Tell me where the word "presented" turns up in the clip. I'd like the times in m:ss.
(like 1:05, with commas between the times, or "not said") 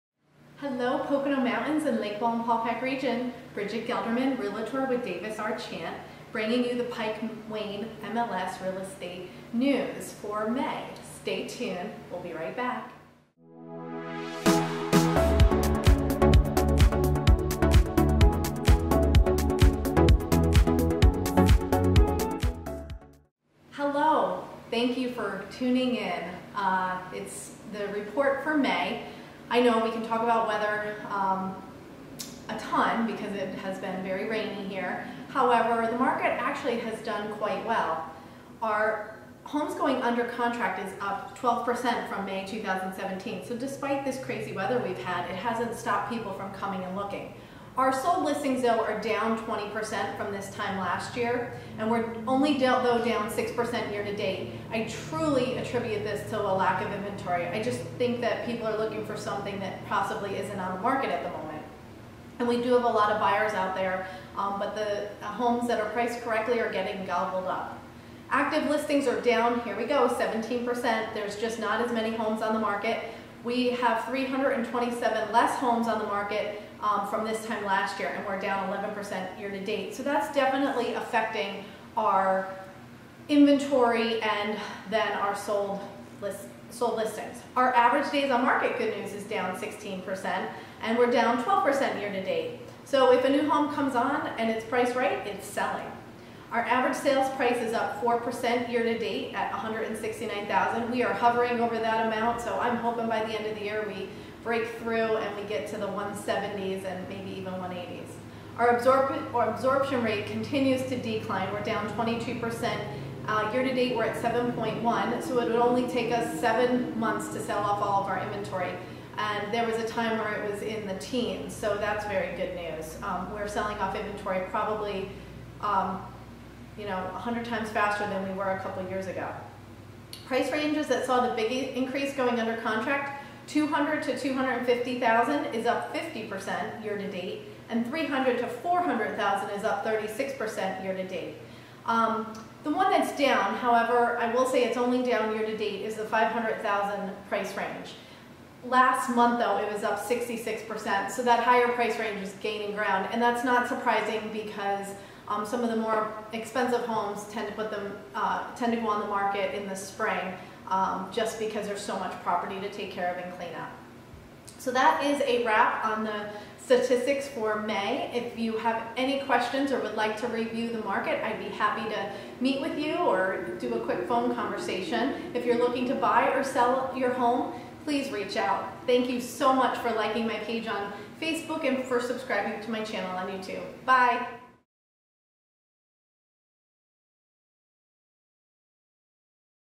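not said.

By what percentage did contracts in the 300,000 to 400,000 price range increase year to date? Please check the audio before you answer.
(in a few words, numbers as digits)
36%.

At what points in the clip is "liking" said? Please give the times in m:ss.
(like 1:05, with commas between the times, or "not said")
2:59.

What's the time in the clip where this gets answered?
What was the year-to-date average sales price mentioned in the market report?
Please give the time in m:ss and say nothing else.
1:39.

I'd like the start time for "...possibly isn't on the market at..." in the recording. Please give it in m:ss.
0:59.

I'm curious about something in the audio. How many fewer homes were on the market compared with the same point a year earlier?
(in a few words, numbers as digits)
327.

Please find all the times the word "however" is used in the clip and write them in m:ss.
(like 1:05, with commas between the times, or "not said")
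0:35, 2:23.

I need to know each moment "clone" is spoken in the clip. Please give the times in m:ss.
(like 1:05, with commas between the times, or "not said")
not said.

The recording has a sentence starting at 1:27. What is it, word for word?
Our average days on market, good news, is down 16%, and we're down 12% year to date.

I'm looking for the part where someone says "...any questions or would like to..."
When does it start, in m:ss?
2:48.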